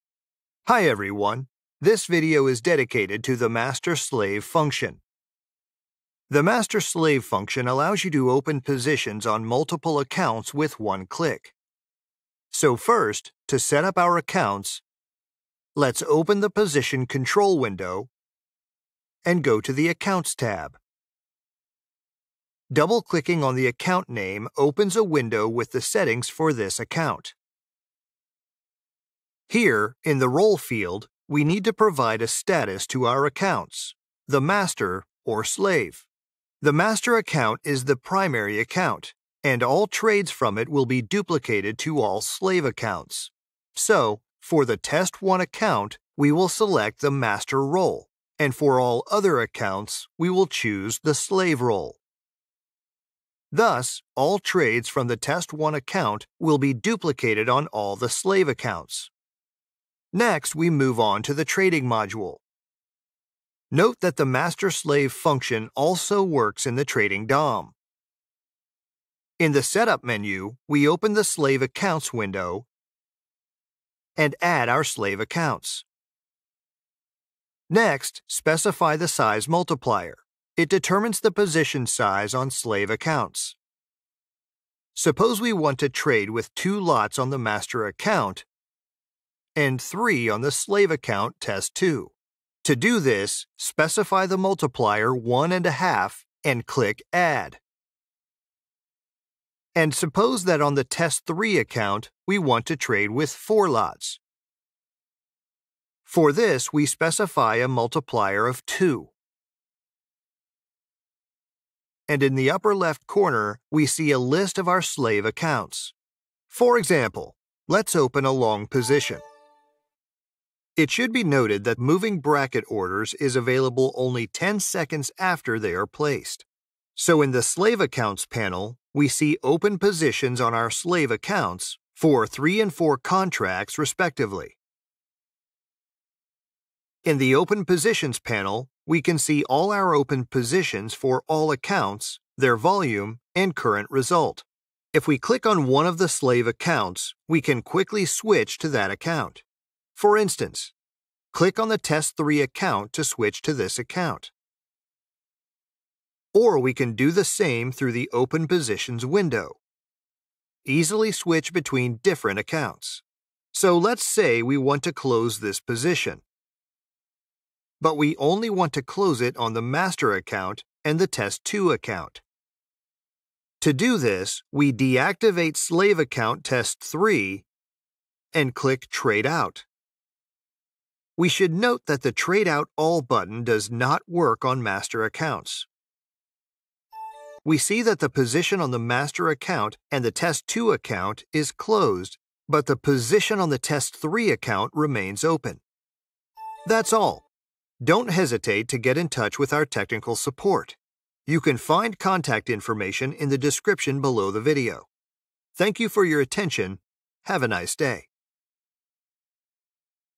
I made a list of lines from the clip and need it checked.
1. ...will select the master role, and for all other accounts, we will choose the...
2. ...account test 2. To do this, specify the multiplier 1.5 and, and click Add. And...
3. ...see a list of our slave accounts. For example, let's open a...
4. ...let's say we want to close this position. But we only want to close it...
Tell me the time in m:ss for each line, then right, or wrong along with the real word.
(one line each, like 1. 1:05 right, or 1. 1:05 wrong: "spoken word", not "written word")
1. 0:46 right
2. 1:30 right
3. 1:53 right
4. 2:43 right.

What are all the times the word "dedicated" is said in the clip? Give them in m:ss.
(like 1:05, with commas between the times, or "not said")
0:02.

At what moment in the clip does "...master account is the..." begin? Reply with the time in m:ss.
0:36.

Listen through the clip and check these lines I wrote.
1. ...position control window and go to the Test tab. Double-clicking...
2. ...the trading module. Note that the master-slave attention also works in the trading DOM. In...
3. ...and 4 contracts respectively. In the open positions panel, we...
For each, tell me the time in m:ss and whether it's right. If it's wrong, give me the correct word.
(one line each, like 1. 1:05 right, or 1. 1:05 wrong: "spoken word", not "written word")
1. 0:16 wrong: "Accounts", not "Test"
2. 1:01 wrong: "function", not "attention"
3. 2:12 right.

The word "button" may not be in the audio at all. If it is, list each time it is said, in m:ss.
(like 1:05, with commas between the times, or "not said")
3:03.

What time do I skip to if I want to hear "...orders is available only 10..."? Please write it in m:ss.
2:02.